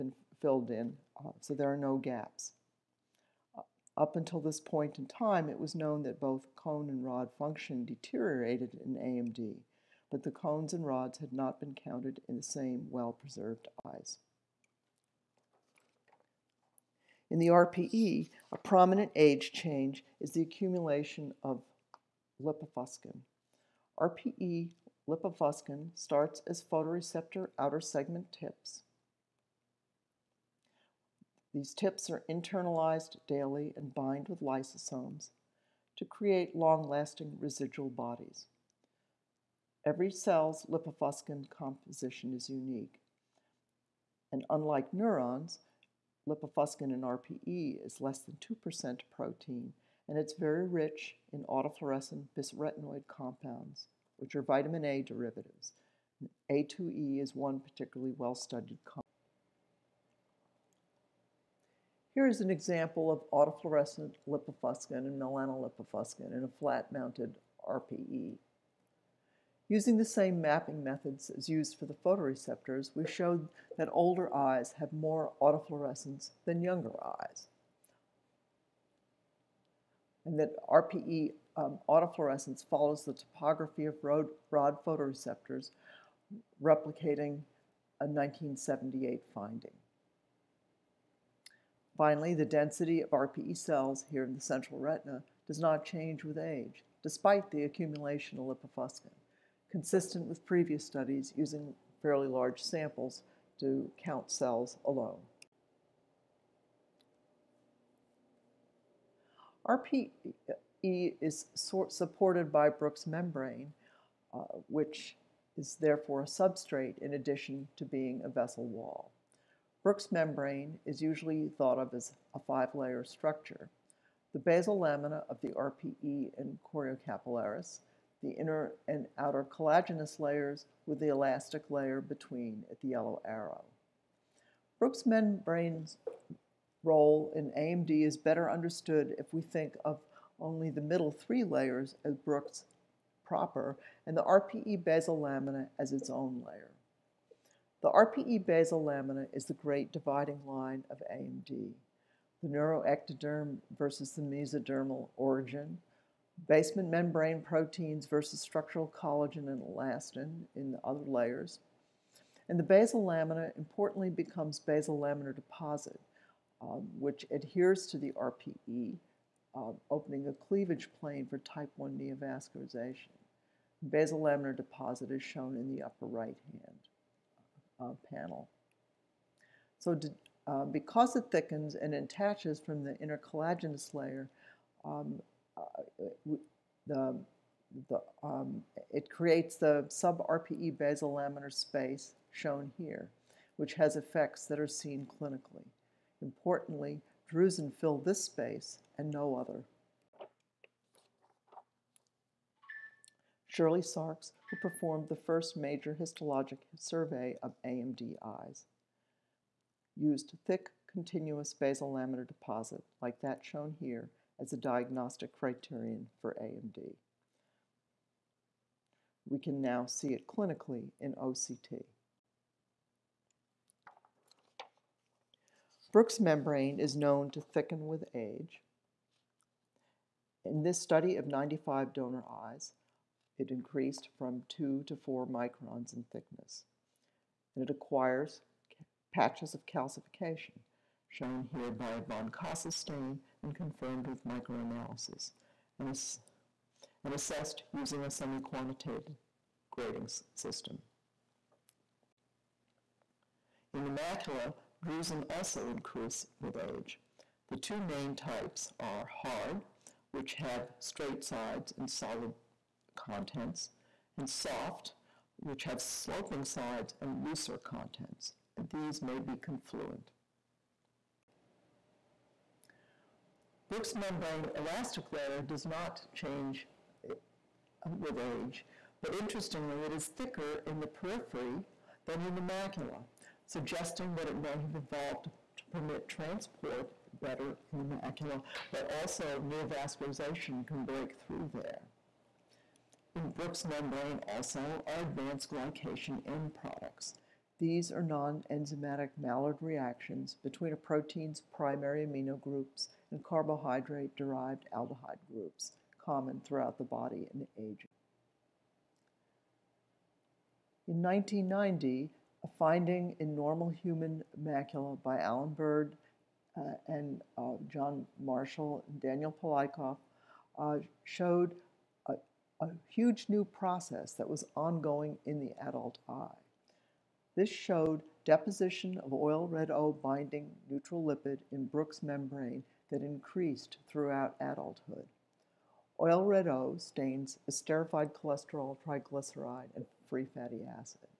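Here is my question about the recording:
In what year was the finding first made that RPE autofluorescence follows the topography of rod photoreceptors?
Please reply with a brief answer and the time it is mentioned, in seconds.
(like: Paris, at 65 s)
1978, at 88 s.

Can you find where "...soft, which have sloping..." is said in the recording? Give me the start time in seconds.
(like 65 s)
264 s.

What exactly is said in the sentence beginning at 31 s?
These tips are internalized daily and bind with lysosomes to create long-lasting residual bodies.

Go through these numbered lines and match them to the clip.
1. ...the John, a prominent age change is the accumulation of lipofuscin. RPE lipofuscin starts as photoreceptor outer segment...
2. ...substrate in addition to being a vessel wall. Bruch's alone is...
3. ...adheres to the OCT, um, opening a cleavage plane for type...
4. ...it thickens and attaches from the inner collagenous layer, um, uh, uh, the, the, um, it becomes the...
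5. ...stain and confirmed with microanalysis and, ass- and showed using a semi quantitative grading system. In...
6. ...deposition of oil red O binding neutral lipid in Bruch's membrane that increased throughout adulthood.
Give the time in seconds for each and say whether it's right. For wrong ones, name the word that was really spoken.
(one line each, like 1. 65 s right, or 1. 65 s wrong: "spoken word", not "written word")
1. 17 s wrong: "RPE", not "John"
2. 116 s wrong: "membrane", not "alone"
3. 167 s wrong: "RPE", not "OCT"
4. 181 s wrong: "creates", not "becomes"
5. 242 s wrong: "assessed", not "showed"
6. 328 s right.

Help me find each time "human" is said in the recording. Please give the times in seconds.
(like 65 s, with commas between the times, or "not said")
313 s.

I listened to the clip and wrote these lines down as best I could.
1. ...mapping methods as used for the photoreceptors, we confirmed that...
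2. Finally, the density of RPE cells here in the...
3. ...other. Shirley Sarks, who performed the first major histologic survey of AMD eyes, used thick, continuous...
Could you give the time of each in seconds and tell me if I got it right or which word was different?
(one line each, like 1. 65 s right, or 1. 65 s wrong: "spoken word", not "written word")
1. 70 s wrong: "showed", not "confirmed"
2. 91 s right
3. 199 s right.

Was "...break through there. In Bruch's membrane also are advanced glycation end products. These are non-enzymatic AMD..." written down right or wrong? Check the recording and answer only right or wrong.
wrong.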